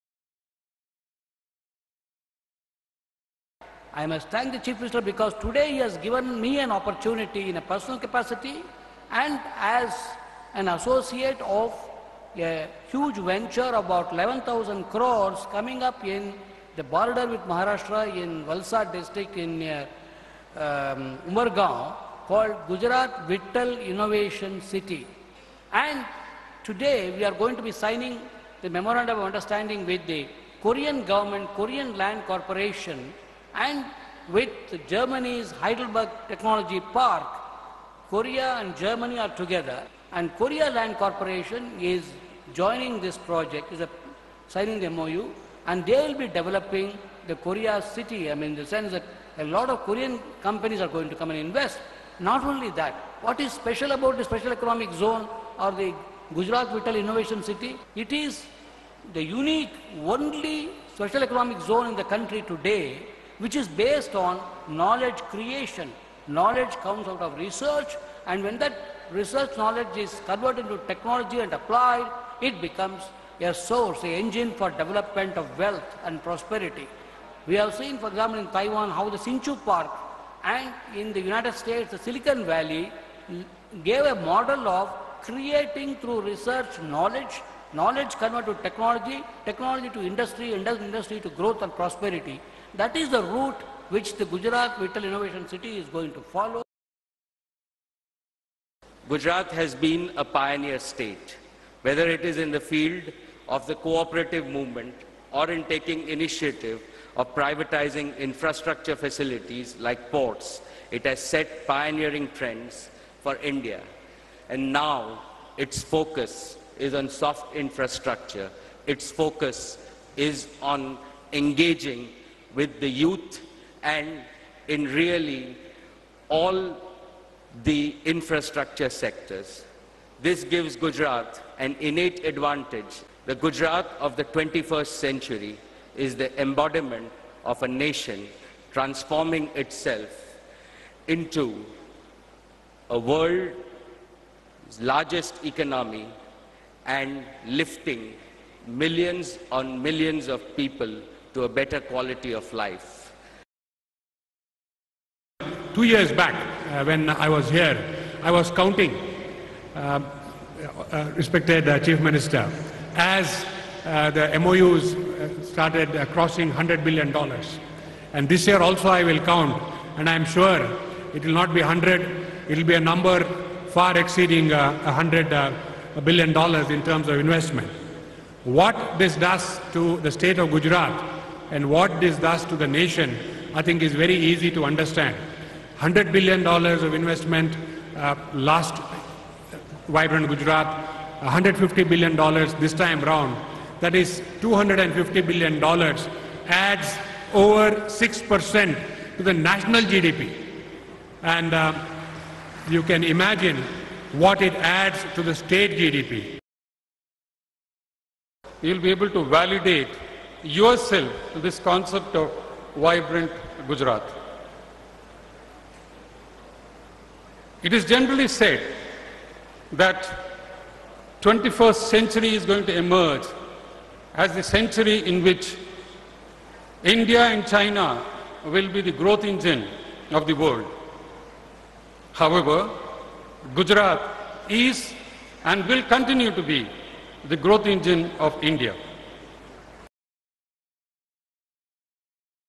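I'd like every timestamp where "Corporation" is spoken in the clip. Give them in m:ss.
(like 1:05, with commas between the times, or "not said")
0:32, 0:40.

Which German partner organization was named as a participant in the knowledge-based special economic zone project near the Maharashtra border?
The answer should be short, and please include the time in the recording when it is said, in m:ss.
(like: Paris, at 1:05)
Heidelberg Technology Park, at 0:35.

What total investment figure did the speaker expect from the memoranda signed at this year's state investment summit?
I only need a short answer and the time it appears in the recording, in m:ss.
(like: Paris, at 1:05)
$150 billion, at 3:11.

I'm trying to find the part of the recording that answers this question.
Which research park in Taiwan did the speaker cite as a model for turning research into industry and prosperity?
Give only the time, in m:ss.
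1:19.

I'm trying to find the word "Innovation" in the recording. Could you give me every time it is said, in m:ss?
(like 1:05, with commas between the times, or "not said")
0:23, 0:56, 1:35.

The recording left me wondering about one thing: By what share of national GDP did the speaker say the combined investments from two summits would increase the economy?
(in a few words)
over 6%.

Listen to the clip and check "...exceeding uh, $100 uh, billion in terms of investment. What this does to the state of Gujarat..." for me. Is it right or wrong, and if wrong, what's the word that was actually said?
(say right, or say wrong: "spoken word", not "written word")
right.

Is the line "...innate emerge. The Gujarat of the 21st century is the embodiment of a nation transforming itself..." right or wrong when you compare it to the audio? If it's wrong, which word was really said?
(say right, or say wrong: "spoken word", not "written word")
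wrong: "advantage", not "emerge".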